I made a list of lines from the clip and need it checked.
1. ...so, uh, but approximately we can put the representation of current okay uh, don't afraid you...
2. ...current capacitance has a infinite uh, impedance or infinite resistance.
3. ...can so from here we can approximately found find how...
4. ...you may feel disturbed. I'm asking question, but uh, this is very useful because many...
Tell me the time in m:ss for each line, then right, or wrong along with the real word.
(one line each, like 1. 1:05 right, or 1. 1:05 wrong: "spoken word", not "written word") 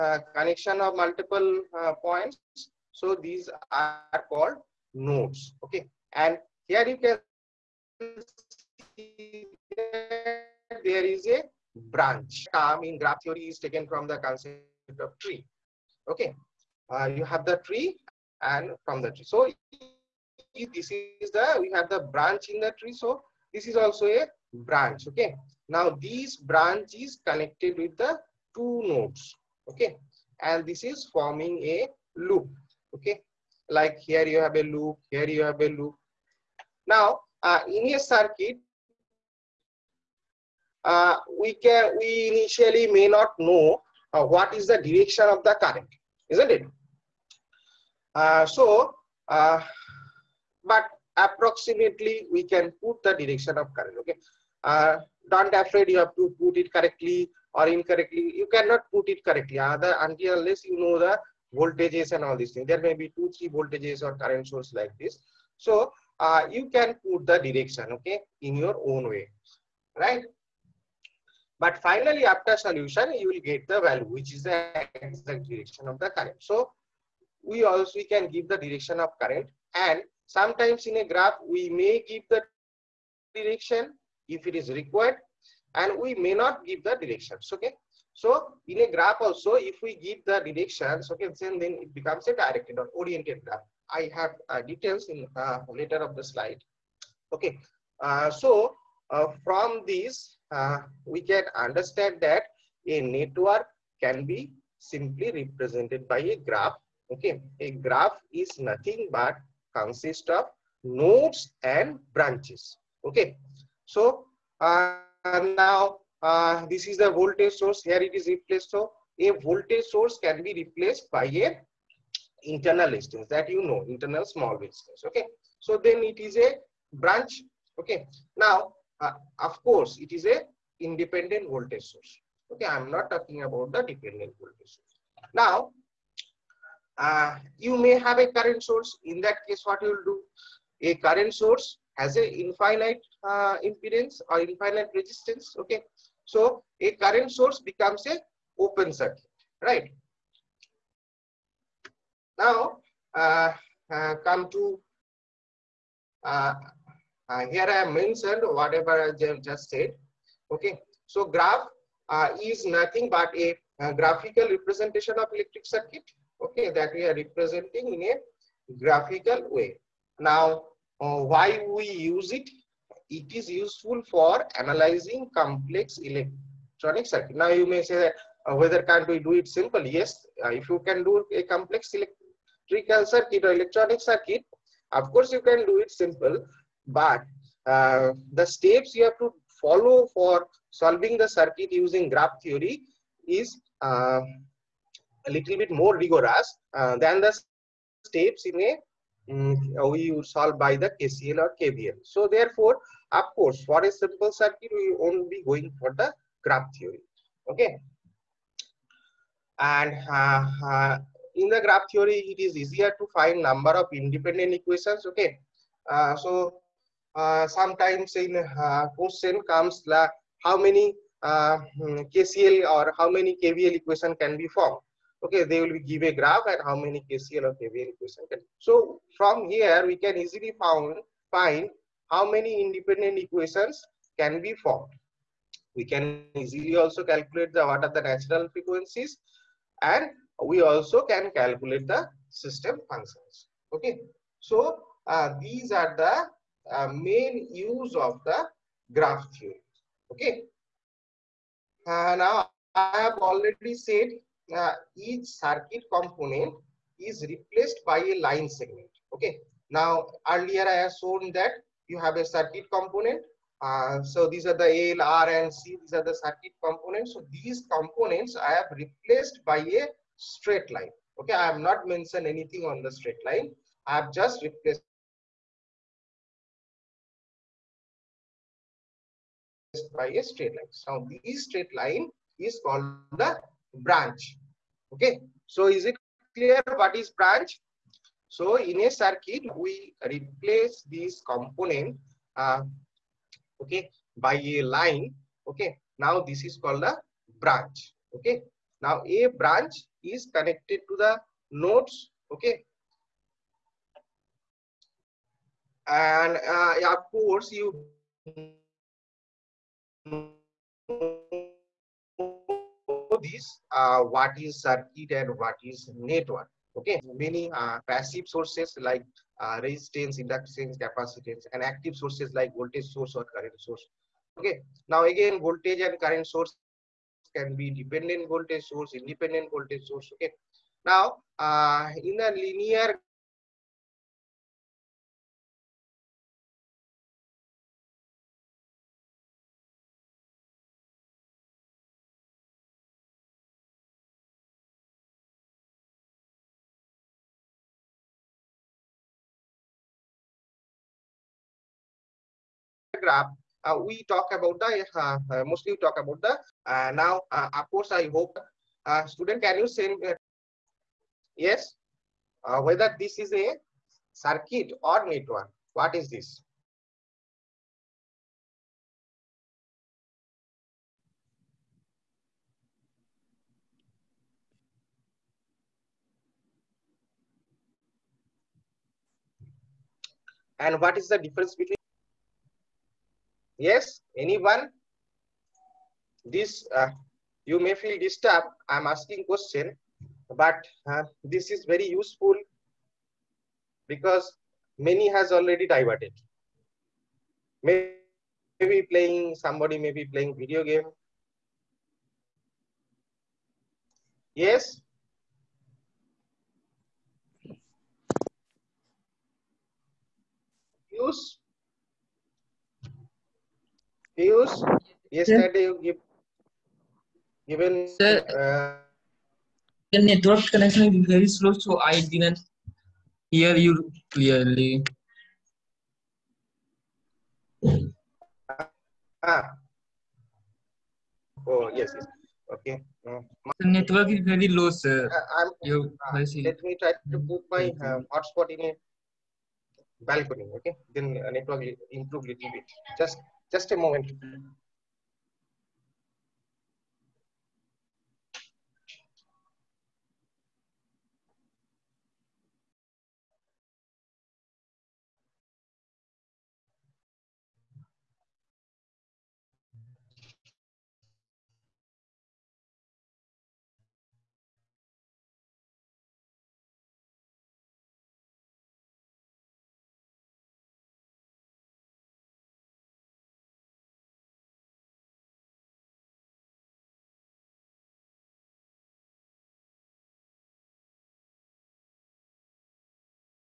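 1. 0:48 wrong: "direction", not "representation"
2. 2:20 wrong: "source", not "capacitance"
3. 3:48 wrong: "easily", not "approximately"
4. 6:27 right.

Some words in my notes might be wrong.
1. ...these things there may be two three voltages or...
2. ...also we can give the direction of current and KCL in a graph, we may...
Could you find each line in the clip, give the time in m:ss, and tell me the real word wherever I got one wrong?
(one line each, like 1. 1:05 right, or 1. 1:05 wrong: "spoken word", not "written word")
1. 1:02 right
2. 1:17 wrong: "Sometimes", not "KCL".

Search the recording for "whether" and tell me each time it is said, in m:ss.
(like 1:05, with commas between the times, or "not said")
2:58, 6:02.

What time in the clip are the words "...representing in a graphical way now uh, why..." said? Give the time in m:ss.
2:47.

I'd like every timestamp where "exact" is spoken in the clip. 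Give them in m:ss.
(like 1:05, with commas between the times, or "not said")
1:15.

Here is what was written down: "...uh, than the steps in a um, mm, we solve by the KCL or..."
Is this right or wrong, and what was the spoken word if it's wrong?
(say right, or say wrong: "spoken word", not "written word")
right.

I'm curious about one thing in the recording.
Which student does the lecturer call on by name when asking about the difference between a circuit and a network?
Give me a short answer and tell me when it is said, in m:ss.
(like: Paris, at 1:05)
Piyush, at 6:54.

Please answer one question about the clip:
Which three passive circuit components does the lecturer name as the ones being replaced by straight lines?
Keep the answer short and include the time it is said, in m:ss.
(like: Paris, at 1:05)
L, R, and C, at 4:24.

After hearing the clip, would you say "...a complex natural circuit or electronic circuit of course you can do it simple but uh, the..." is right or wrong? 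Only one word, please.
wrong.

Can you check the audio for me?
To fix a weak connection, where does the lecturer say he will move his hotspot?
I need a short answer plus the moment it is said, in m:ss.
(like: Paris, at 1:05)
balcony, at 7:20.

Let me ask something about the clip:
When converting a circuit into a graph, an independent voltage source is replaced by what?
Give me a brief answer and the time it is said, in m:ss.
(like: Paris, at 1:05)
internal resistance, at 2:02.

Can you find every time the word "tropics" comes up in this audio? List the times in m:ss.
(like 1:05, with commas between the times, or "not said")
not said.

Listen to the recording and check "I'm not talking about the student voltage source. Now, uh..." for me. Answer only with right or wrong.
wrong.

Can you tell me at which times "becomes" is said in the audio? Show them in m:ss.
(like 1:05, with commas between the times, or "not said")
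1:31, 2:27.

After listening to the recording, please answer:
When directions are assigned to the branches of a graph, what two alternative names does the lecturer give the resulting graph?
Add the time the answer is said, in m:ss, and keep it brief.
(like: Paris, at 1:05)
directed or oriented graph, at 1:32.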